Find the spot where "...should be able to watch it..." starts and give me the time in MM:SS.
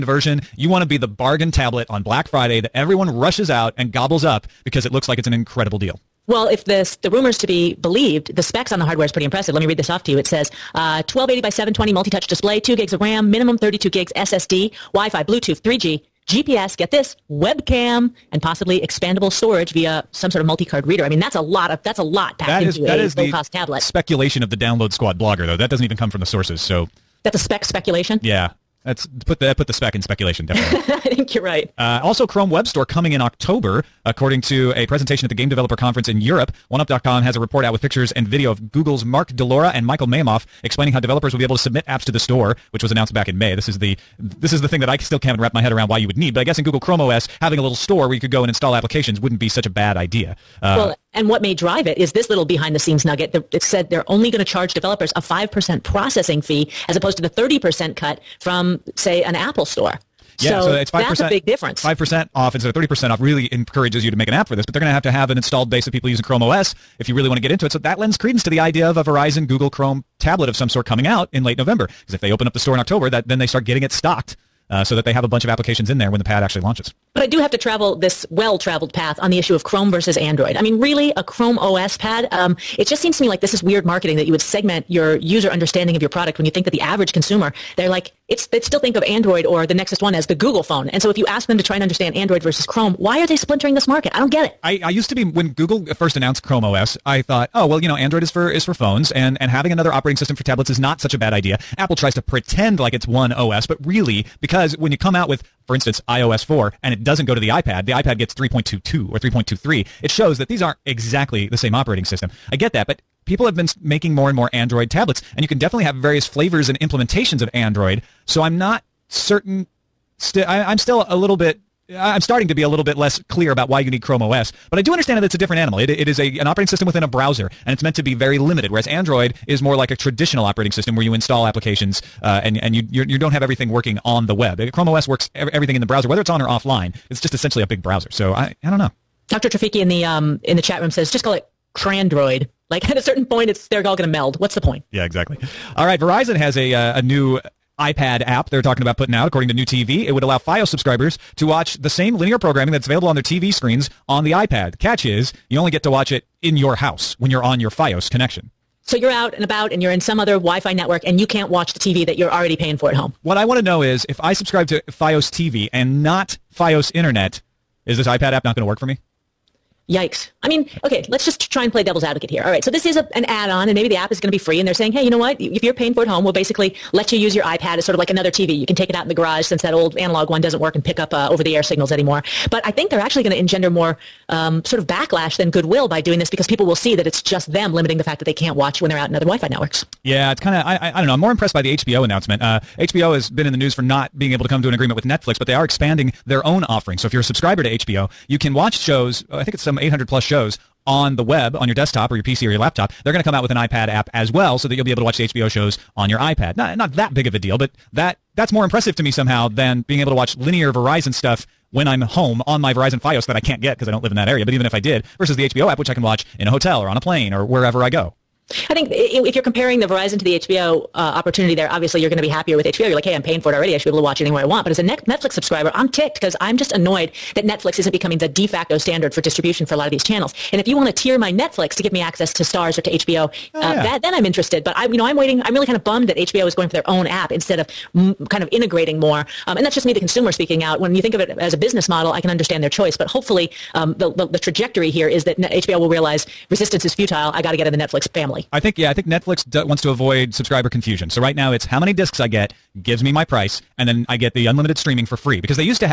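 03:43.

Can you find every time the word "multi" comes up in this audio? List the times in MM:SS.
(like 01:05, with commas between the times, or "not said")
00:11, 00:20.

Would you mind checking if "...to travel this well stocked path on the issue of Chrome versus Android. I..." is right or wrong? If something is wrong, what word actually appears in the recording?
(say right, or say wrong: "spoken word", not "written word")
wrong: "traveled", not "stocked".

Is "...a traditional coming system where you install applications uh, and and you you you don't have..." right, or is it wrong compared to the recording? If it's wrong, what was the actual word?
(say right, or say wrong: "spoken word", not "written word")
wrong: "operating", not "coming".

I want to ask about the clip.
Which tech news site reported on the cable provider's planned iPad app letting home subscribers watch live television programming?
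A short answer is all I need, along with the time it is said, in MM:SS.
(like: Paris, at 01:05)
NewTeeVee, at 02:29.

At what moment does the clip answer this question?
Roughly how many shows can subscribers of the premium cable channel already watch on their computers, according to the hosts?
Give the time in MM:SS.
03:19.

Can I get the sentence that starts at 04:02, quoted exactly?
But hopefully, um, the, the, the, trajectory here is that HBO will realize resistance is futile.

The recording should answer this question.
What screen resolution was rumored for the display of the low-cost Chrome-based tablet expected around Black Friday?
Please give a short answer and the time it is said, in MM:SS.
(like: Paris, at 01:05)
1280 by 720, at 00:11.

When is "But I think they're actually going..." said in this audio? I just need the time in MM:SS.
03:02.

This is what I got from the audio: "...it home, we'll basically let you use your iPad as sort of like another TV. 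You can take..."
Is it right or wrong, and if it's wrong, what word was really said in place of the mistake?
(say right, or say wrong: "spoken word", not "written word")
right.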